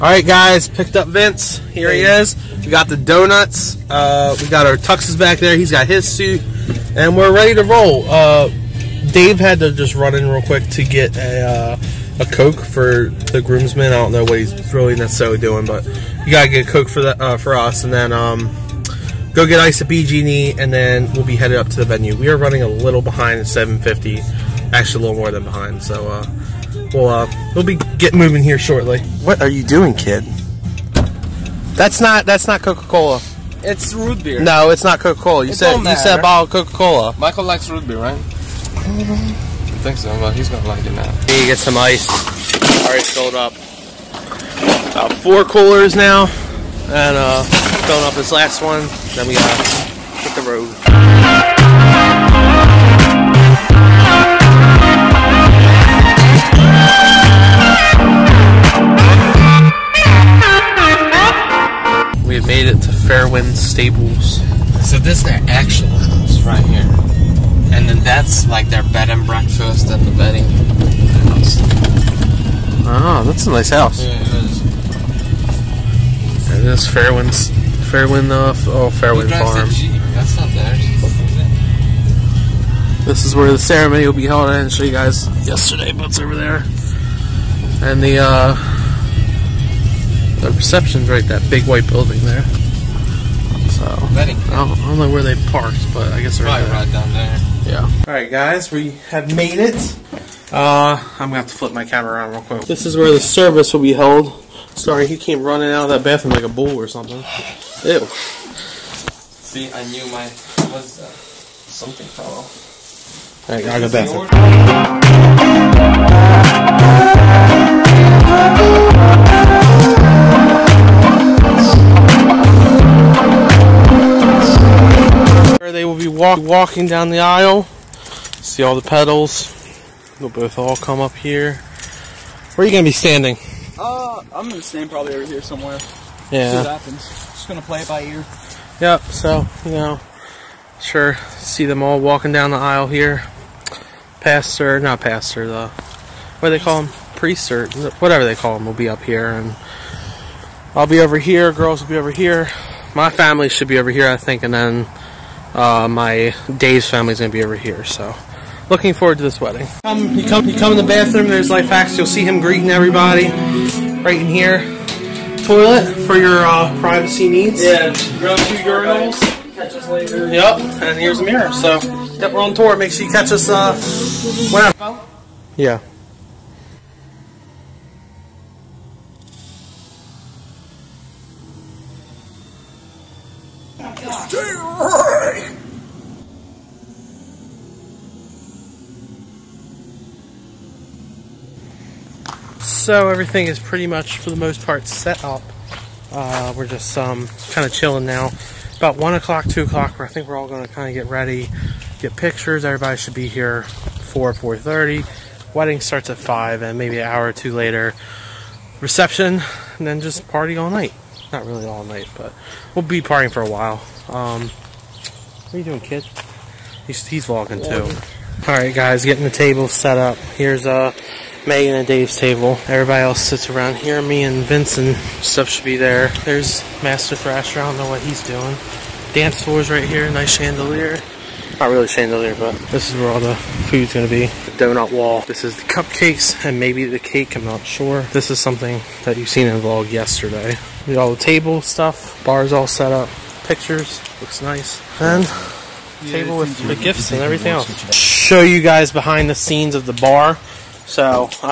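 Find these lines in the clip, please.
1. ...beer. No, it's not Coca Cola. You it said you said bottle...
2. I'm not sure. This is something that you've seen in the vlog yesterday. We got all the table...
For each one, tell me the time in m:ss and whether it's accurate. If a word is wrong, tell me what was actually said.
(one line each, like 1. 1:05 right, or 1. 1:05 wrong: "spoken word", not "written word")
1. 0:34 right
2. 3:57 right.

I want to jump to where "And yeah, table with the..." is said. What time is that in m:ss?
4:04.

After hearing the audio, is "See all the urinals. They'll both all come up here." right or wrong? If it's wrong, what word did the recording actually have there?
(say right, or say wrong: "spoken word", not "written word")
wrong: "pedals", not "urinals".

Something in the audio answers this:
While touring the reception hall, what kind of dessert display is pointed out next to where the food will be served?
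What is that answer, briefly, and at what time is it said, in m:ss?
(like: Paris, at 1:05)
Donut wall, at 3:54.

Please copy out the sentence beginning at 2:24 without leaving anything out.
Pastor, not pastor, the, what do they call them?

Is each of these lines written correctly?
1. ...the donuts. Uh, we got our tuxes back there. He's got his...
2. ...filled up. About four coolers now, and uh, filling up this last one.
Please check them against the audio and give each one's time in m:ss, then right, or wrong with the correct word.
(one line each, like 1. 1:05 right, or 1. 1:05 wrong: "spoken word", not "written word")
1. 0:02 right
2. 0:43 right.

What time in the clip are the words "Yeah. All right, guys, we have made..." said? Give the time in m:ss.
1:37.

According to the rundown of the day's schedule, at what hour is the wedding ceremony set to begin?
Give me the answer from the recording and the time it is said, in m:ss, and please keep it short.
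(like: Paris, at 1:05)
5, at 3:25.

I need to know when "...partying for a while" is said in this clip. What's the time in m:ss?
3:32.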